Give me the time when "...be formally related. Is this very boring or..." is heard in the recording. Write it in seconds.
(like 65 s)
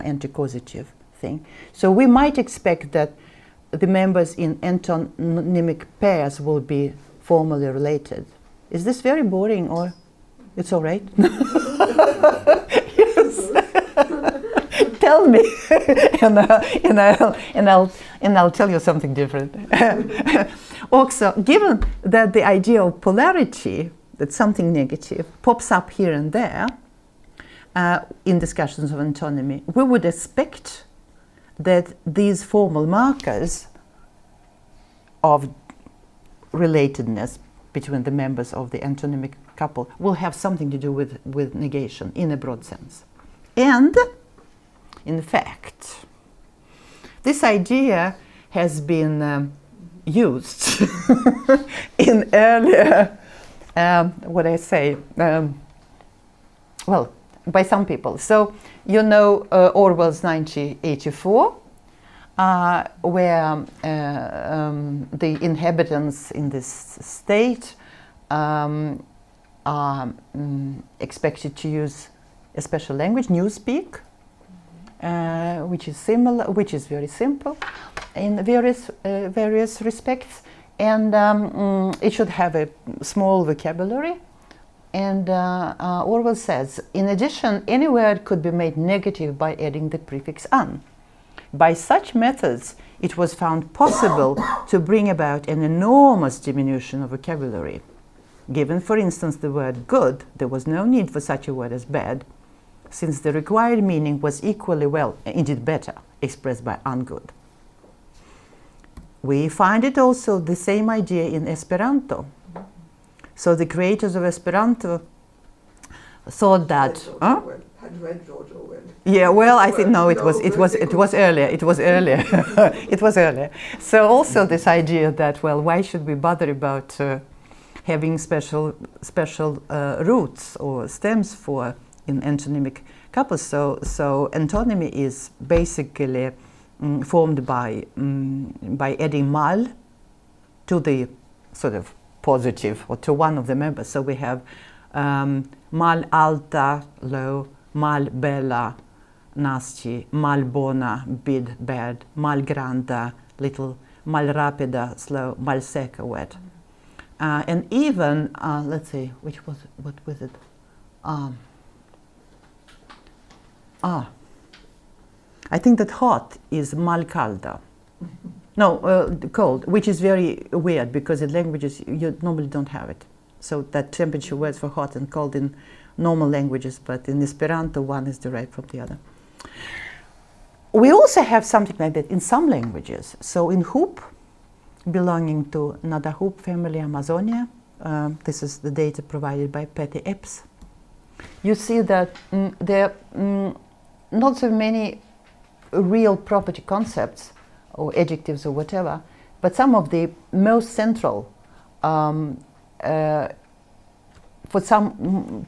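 6 s.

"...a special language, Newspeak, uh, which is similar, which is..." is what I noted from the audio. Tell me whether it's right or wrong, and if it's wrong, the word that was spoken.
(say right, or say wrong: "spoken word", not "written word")
right.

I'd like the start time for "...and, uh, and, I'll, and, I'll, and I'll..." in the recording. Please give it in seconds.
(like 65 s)
16 s.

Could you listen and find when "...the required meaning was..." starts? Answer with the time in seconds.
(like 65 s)
103 s.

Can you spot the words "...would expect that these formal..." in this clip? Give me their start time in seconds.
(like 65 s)
29 s.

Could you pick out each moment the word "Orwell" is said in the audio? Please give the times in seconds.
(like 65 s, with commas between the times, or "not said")
59 s, 86 s.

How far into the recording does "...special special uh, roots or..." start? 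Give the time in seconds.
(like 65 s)
128 s.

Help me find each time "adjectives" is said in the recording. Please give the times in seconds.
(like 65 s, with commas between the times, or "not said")
197 s.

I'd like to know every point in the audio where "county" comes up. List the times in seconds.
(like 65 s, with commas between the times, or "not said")
not said.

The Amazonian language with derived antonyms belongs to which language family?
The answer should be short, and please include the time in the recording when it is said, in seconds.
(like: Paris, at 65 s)
Nadahup, at 185 s.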